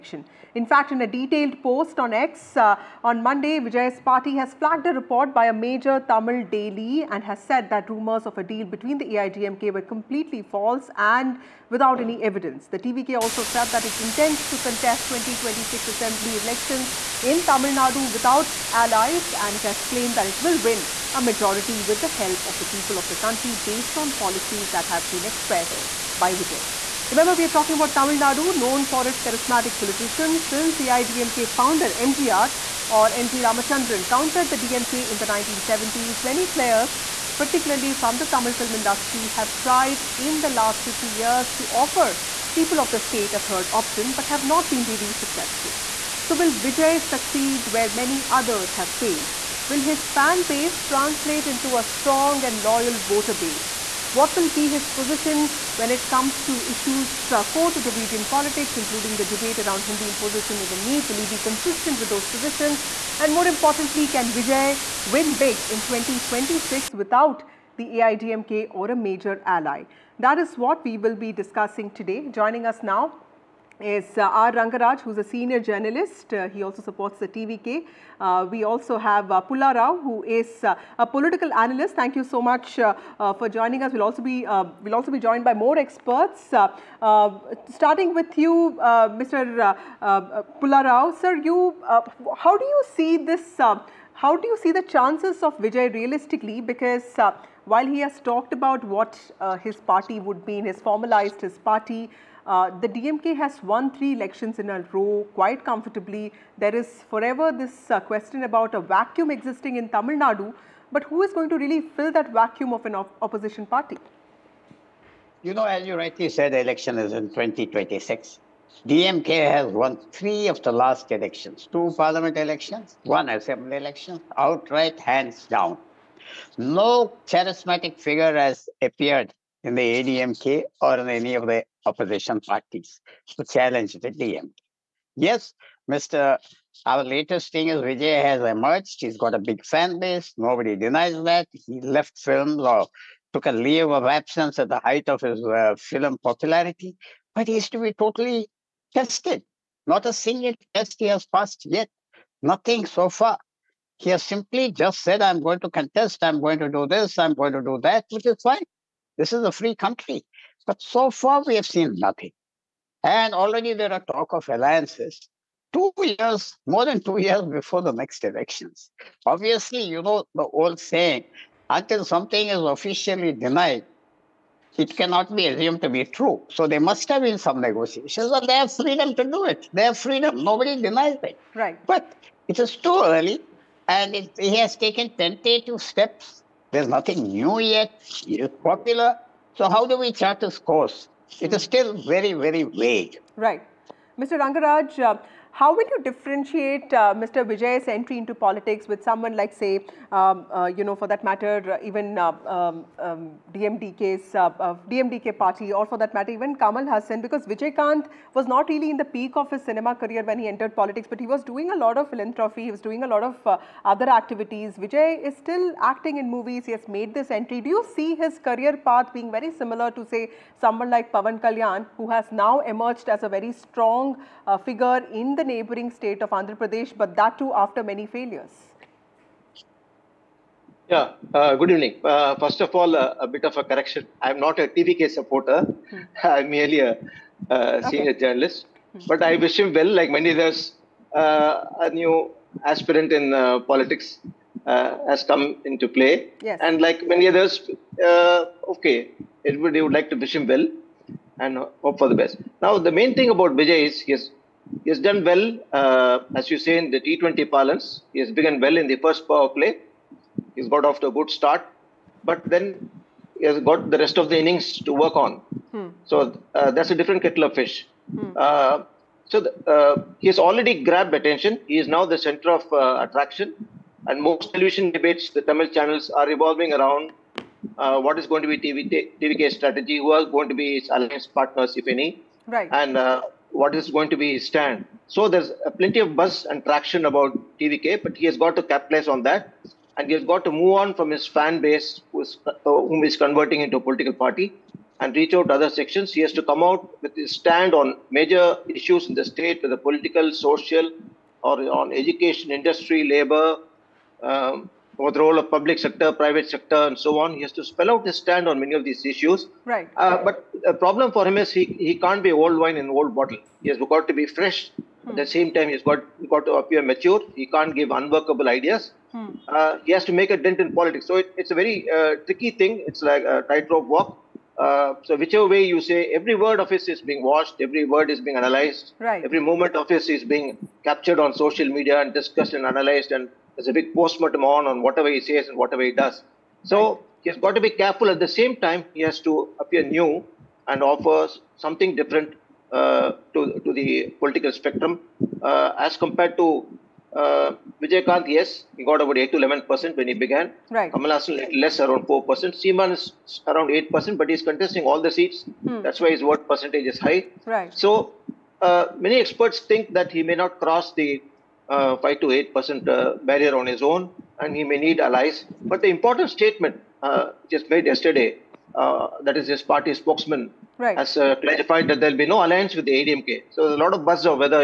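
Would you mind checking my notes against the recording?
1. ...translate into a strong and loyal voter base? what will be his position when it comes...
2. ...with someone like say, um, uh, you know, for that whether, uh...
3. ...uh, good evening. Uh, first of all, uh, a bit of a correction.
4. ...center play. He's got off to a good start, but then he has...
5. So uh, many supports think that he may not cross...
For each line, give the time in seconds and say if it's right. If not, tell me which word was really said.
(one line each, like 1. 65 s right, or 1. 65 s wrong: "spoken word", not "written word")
1. 50 s right
2. 198 s wrong: "matter", not "whether"
3. 231 s right
4. 259 s wrong: "power", not "center"
5. 357 s wrong: "experts", not "supports".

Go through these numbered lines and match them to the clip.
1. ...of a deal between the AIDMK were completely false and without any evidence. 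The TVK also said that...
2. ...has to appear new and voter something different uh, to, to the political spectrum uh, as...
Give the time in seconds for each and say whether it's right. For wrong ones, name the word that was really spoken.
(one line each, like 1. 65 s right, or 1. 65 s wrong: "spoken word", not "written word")
1. 8 s right
2. 339 s wrong: "offer", not "voter".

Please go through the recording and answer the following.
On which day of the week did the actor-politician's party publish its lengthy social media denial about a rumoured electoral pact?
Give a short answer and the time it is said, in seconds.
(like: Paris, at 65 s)
Monday, at 3 s.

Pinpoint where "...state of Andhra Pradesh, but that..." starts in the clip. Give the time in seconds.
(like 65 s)
225 s.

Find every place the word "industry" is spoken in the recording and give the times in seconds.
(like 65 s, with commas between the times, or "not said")
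38 s, 302 s.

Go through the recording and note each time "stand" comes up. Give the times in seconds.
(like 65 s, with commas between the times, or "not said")
284 s, 297 s, 308 s.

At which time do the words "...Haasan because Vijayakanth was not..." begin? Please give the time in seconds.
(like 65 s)
206 s.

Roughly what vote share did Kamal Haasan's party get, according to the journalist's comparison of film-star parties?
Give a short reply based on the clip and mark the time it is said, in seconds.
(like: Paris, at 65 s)
Around 4%, at 351 s.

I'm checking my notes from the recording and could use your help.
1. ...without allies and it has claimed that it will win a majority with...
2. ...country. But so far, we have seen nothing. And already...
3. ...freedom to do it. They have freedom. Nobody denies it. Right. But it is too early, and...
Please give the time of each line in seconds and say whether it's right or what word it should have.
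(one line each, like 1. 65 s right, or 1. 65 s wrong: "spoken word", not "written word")
1. 18 s right
2. 159 s right
3. 178 s right.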